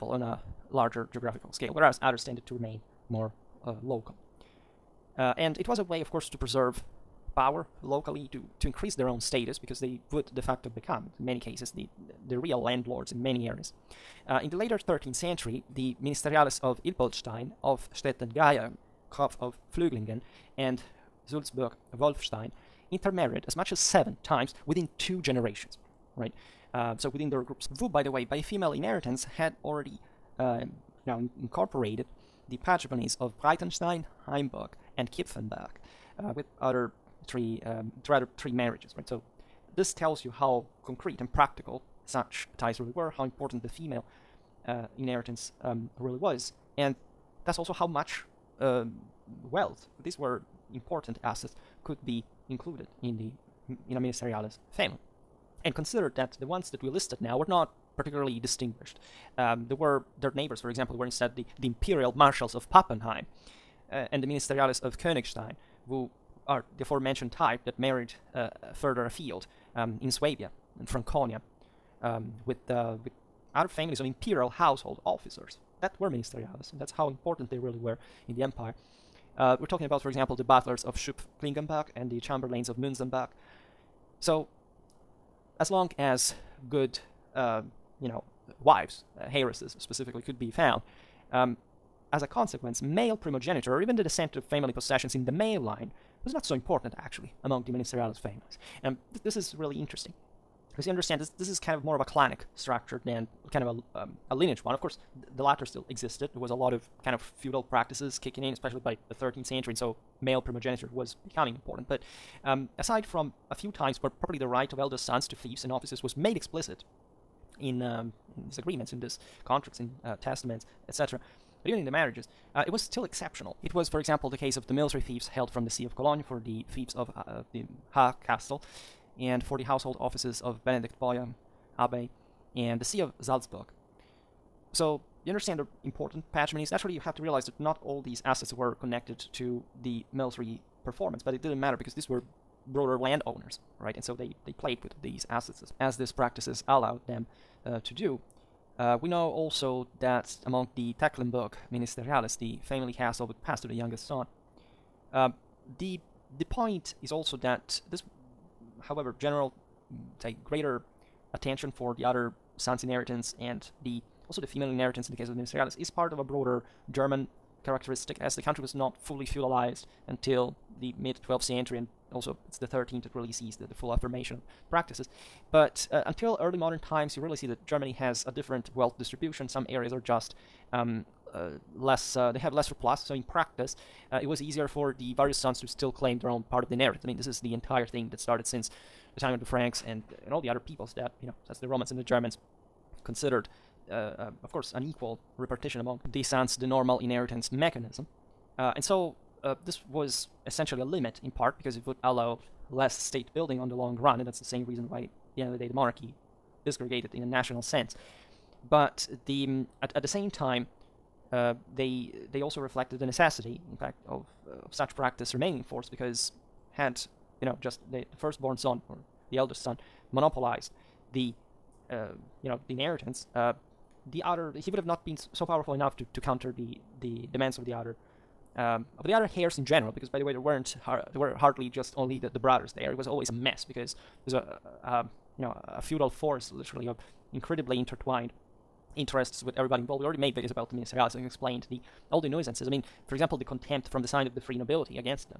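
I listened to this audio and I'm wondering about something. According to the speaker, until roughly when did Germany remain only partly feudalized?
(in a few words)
mid 12th century.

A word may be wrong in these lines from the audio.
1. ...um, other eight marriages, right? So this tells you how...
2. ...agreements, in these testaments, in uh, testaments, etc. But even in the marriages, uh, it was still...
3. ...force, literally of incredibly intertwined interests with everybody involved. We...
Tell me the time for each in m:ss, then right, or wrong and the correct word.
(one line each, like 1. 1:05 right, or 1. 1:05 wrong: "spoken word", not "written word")
1. 0:37 wrong: "three", not "eight"
2. 1:58 wrong: "contracts", not "testaments"
3. 3:56 right.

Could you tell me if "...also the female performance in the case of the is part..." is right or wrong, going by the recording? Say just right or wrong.
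wrong.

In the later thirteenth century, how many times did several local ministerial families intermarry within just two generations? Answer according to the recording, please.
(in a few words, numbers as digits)
7.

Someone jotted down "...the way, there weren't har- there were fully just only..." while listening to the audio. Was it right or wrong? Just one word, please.
wrong.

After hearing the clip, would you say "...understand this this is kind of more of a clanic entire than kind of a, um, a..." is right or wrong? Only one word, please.
wrong.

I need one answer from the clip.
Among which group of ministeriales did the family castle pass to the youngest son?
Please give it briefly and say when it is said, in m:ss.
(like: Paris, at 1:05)
Tecklenburg, at 2:30.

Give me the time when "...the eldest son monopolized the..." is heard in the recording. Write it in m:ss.
3:39.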